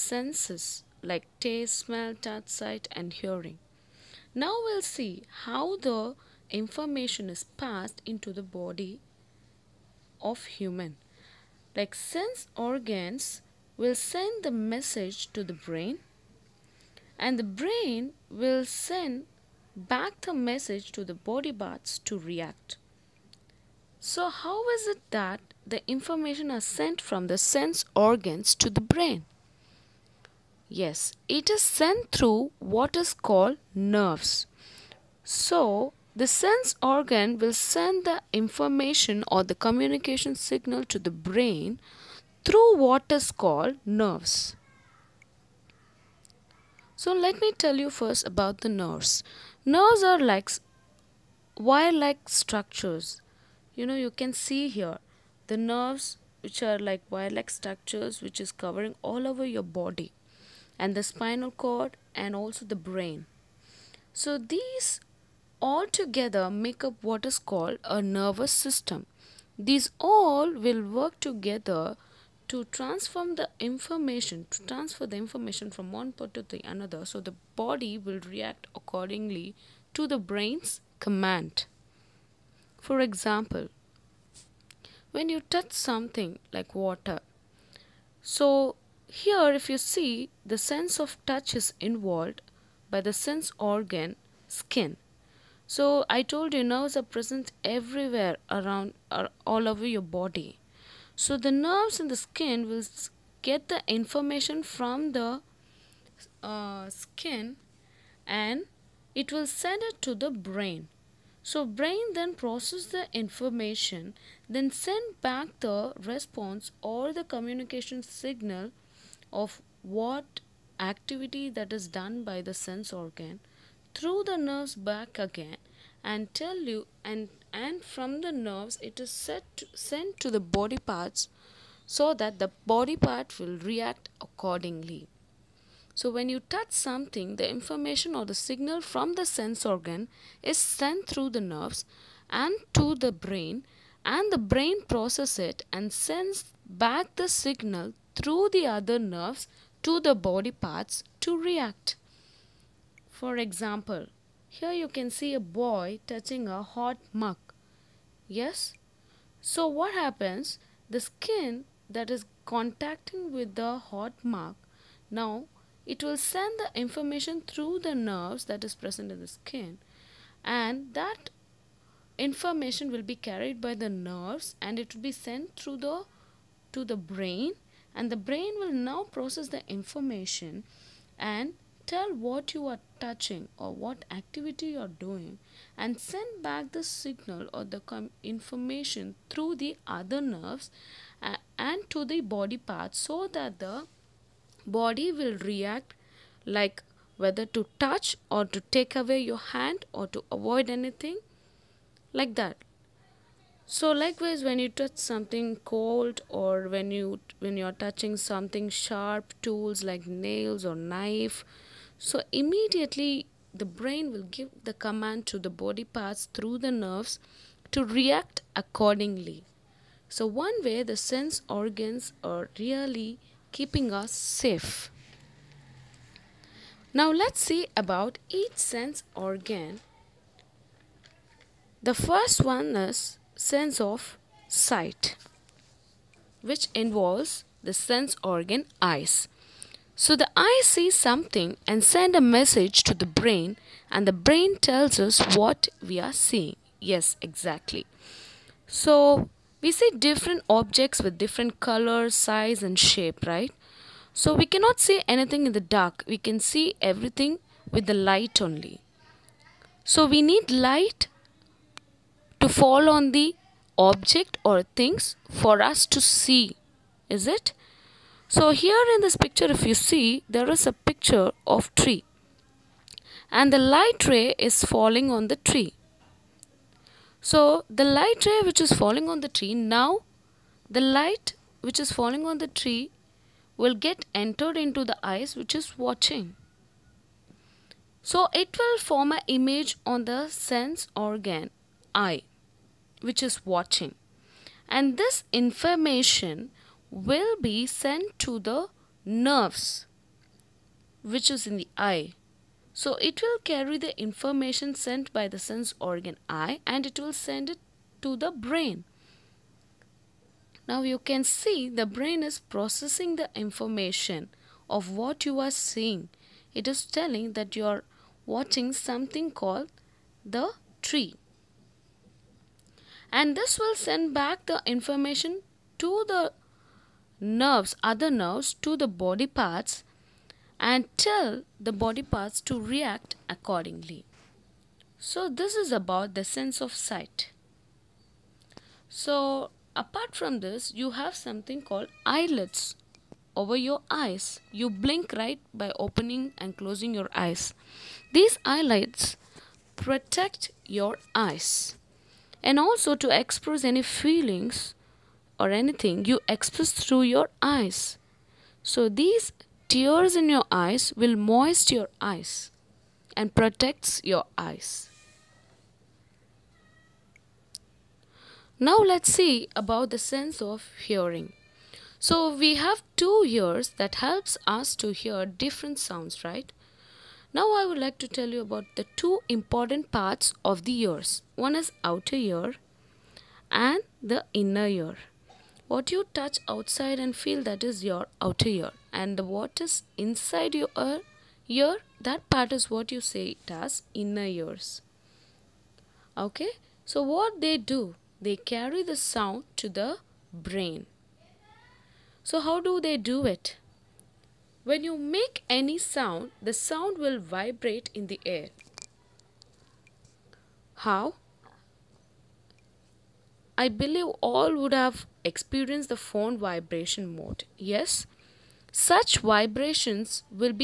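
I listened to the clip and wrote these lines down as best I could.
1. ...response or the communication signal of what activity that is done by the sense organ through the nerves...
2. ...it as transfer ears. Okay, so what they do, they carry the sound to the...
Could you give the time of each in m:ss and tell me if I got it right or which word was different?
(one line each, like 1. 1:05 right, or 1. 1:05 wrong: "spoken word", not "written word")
1. 1:56 right
2. 6:33 wrong: "inner", not "transfer".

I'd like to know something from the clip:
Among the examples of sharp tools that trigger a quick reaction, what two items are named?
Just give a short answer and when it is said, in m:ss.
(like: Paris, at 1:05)
nails or knife, at 3:30.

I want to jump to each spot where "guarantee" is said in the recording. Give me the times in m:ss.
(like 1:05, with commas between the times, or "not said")
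not said.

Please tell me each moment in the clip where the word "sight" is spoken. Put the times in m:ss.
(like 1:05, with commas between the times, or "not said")
0:02, 3:54, 5:36.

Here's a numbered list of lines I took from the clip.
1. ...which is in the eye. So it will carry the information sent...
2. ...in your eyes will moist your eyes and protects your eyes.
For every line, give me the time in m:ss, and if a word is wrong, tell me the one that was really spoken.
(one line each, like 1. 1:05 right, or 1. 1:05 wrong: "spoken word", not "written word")
1. 5:01 right
2. 6:00 right.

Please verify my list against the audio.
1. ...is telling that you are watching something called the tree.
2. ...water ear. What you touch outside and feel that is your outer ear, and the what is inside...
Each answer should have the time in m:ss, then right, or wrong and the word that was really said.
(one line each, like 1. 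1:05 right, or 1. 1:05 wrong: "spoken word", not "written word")
1. 5:16 right
2. 6:24 wrong: "inner", not "water".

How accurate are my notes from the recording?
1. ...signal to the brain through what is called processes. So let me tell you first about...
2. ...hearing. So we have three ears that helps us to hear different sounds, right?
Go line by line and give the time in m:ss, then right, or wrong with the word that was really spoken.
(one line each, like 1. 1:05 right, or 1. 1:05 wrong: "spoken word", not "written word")
1. 0:40 wrong: "nerves", not "processes"
2. 6:10 wrong: "two", not "three".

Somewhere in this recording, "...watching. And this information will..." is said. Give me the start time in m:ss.
4:53.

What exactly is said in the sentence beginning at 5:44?
You blink right by opening and closing your eyes.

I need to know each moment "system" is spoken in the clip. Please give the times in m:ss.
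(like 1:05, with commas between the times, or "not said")
1:08.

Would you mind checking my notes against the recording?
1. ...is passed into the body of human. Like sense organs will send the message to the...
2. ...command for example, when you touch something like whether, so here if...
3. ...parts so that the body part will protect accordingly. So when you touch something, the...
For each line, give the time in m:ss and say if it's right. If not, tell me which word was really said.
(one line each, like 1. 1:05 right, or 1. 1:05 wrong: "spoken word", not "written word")
1. 0:07 right
2. 1:21 wrong: "water", not "whether"
3. 2:10 wrong: "react", not "protect".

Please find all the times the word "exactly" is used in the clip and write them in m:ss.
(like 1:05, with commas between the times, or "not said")
4:07.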